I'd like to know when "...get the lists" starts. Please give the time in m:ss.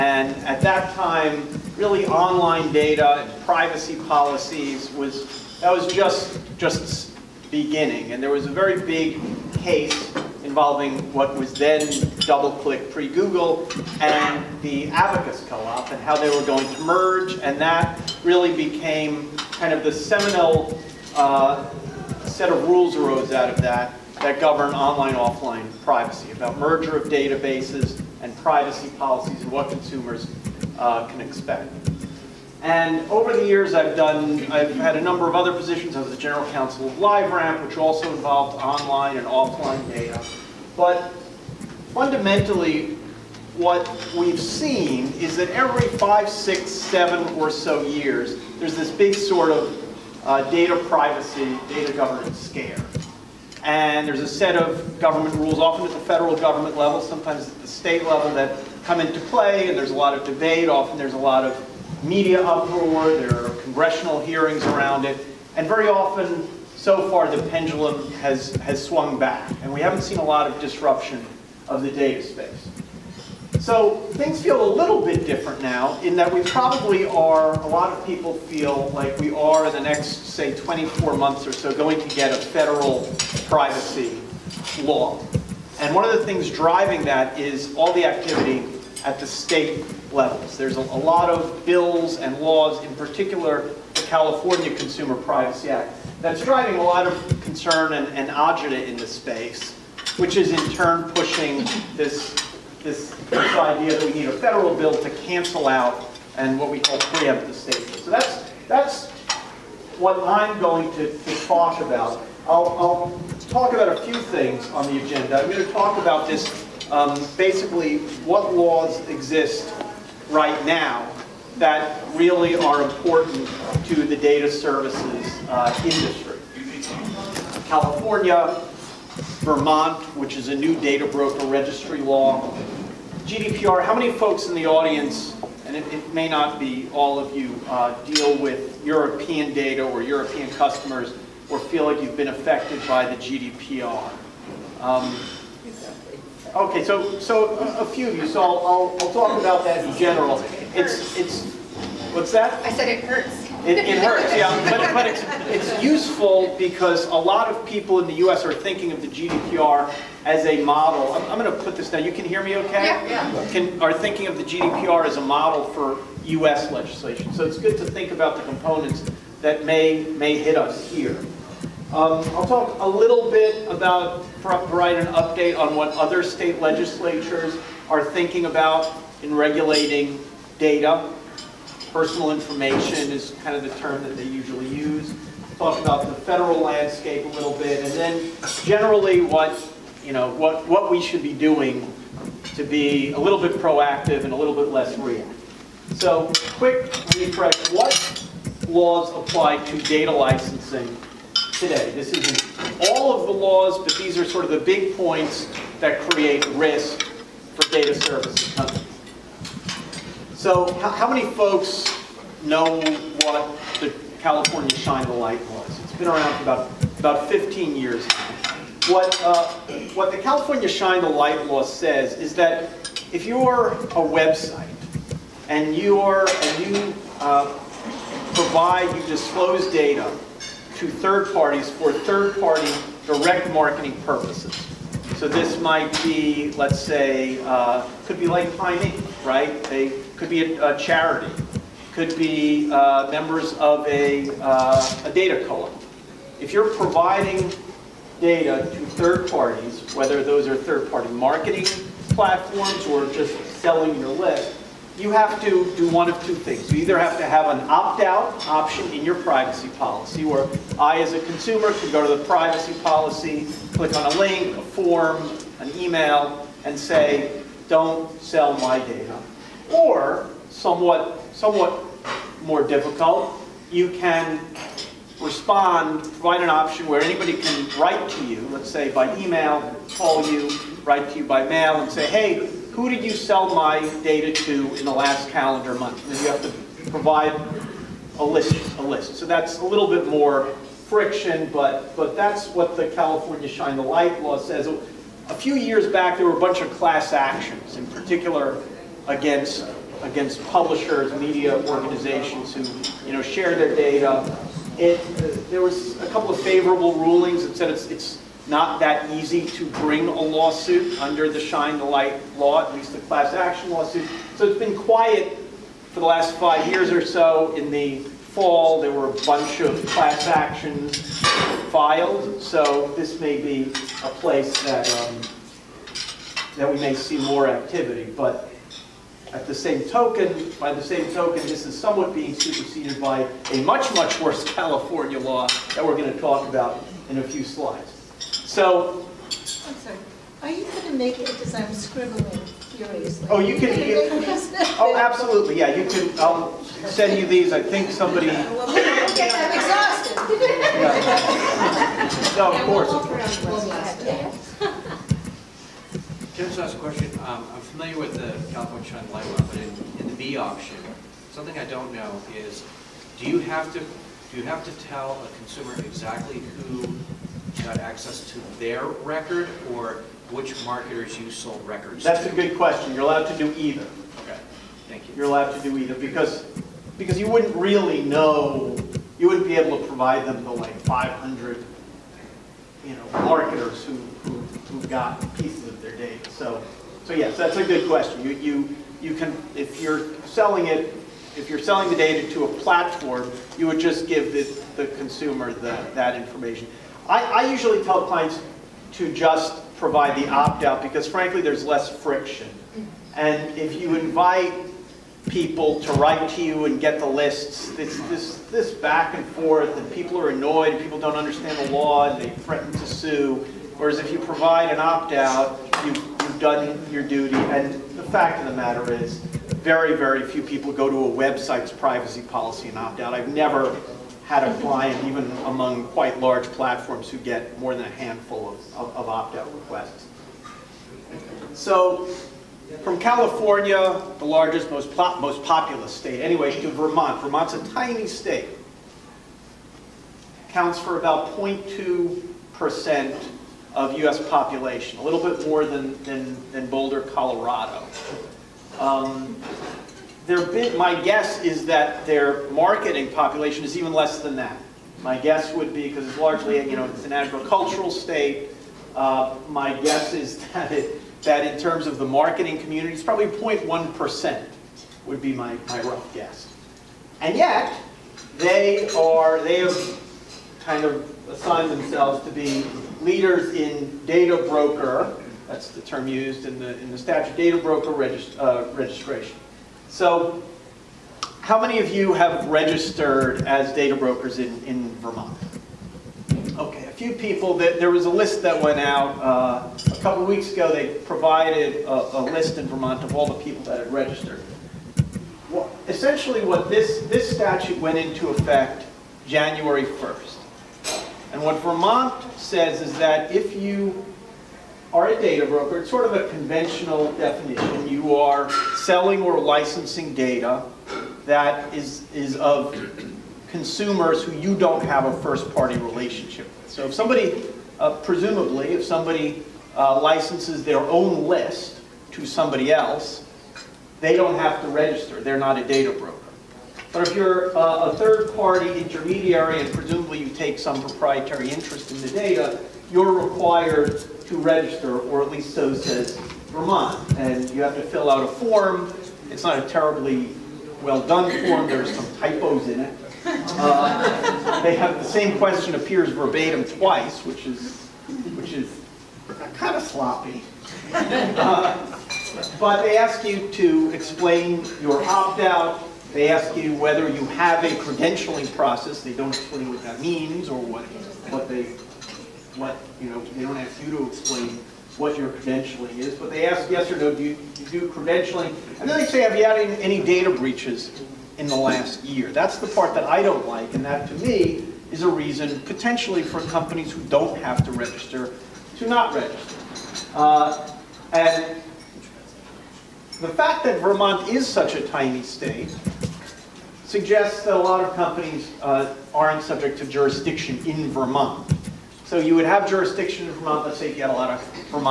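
6:46.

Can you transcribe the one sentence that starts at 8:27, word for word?
You are selling or licensing data that is, is of consumers who you don't have a first-party relationship with.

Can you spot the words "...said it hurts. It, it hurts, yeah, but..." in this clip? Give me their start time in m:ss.
2:32.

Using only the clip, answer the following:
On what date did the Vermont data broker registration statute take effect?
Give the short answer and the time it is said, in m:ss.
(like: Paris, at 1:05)
January 1st, at 8:19.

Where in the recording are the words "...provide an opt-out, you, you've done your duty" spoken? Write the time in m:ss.
6:54.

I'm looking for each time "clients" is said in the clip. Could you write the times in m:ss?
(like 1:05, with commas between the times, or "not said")
6:38, 7:04.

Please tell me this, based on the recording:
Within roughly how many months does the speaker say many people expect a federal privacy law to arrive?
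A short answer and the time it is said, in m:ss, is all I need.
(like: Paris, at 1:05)
24 months, at 1:20.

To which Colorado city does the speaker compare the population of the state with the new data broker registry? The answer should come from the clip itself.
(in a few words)
Boulder.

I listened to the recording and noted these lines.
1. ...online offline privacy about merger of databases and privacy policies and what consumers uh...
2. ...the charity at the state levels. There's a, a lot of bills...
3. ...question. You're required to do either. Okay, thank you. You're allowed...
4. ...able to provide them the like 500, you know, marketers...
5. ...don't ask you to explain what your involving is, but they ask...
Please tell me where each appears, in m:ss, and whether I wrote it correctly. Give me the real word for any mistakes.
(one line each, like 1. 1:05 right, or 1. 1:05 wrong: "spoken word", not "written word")
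1. 0:24 right
2. 1:27 wrong: "activity", not "charity"
3. 6:12 wrong: "allowed", not "required"
4. 6:19 right
5. 9:23 wrong: "credentialing", not "involving".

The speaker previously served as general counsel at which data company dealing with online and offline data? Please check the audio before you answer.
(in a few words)
LiveRamp.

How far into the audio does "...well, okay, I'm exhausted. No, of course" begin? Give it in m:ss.
5:48.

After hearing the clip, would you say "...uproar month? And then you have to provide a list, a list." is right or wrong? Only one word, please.
wrong.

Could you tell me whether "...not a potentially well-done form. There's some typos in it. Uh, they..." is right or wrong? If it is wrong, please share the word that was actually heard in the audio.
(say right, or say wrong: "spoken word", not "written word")
wrong: "terribly", not "potentially".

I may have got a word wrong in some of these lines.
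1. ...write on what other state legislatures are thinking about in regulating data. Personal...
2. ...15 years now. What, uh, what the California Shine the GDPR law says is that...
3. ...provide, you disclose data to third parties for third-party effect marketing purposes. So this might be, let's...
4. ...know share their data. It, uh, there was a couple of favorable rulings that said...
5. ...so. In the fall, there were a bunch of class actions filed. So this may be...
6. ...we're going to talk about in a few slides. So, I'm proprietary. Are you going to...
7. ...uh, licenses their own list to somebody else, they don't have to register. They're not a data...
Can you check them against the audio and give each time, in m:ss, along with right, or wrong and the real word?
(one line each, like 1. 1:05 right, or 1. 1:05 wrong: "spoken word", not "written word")
1. 2:55 wrong: "update", not "write"
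2. 3:37 wrong: "Light", not "GDPR"
3. 3:48 wrong: "direct", not "effect"
4. 5:03 right
5. 5:17 right
6. 5:35 wrong: "sorry", not "proprietary"
7. 8:39 right.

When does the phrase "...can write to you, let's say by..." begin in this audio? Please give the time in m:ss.
4:37.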